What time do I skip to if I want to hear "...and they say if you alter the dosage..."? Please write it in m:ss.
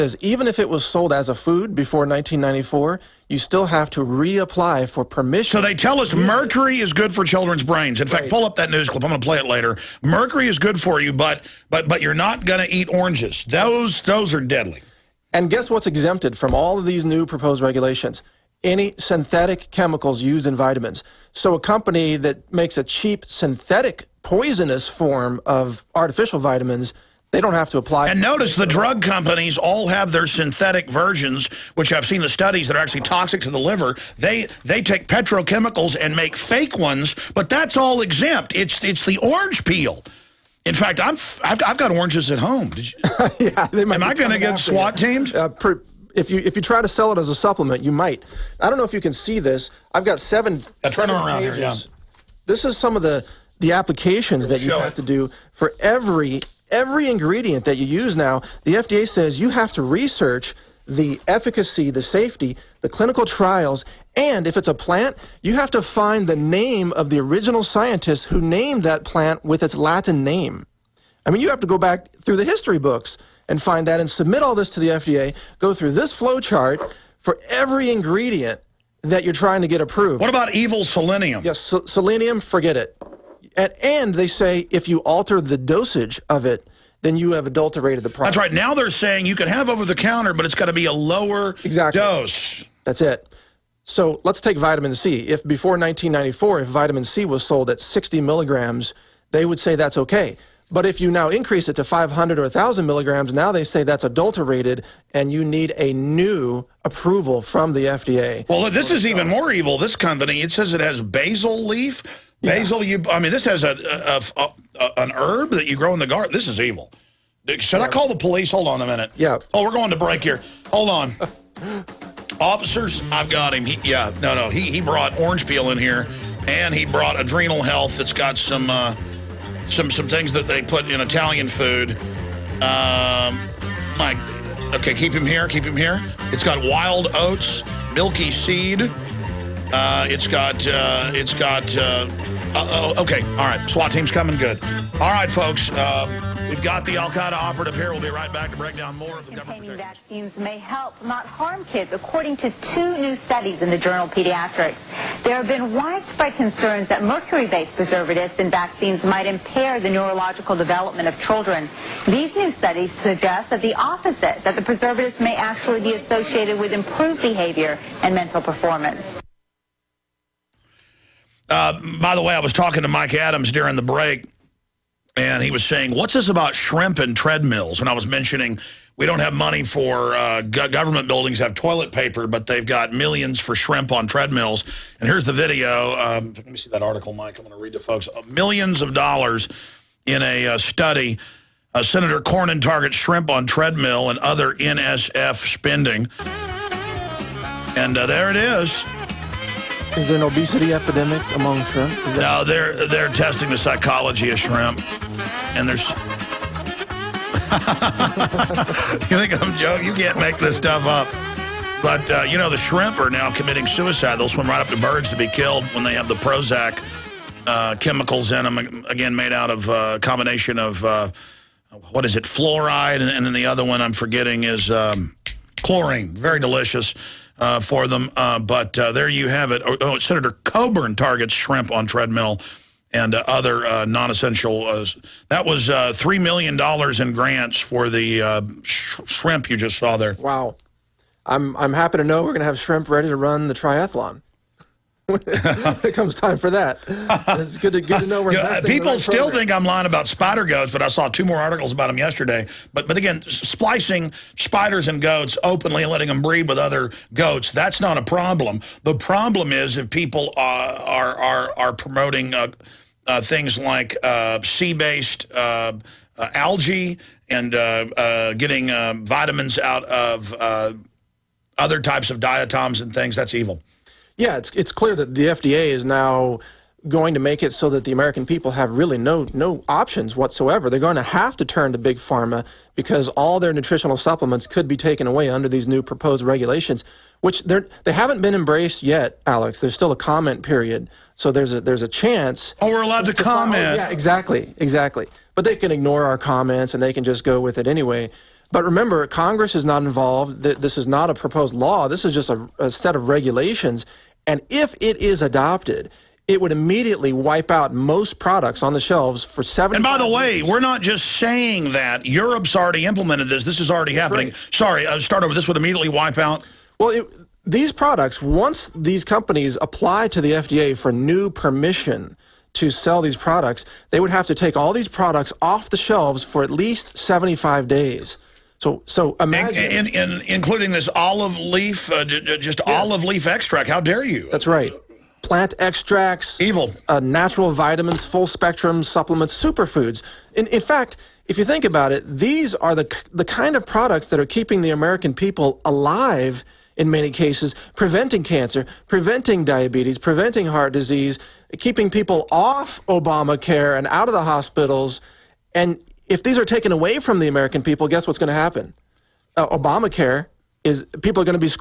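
1:23.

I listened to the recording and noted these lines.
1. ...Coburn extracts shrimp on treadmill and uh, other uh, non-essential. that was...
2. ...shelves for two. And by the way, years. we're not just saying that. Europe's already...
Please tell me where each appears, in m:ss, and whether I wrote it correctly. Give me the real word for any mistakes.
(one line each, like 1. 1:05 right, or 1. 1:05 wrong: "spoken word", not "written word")
1. 3:50 wrong: "targets", not "extracts"
2. 5:08 wrong: "seven", not "two".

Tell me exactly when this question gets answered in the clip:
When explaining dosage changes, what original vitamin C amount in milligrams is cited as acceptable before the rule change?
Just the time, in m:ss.
1:37.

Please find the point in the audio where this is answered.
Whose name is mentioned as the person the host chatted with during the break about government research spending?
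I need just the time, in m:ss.
2:52.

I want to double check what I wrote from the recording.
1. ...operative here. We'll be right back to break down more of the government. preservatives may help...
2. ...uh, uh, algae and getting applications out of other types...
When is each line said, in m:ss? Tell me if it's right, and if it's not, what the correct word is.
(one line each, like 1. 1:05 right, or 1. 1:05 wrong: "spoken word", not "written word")
1. 2:27 wrong: "vaccines", not "preservatives"
2. 4:25 wrong: "vitamins", not "applications".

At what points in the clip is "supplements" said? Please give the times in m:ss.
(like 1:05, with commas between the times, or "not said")
0:47, 4:43, 5:38.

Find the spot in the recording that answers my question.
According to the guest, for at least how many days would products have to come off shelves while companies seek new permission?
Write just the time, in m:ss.
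5:26.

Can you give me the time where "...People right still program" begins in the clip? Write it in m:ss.
4:08.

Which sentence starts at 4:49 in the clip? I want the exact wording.
There's still a comment period, so there's a there's a chance.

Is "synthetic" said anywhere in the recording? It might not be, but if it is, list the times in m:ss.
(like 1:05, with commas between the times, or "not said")
0:18, 0:23, 0:30.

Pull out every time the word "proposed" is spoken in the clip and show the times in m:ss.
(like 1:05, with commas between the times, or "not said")
0:17, 4:45, 5:01.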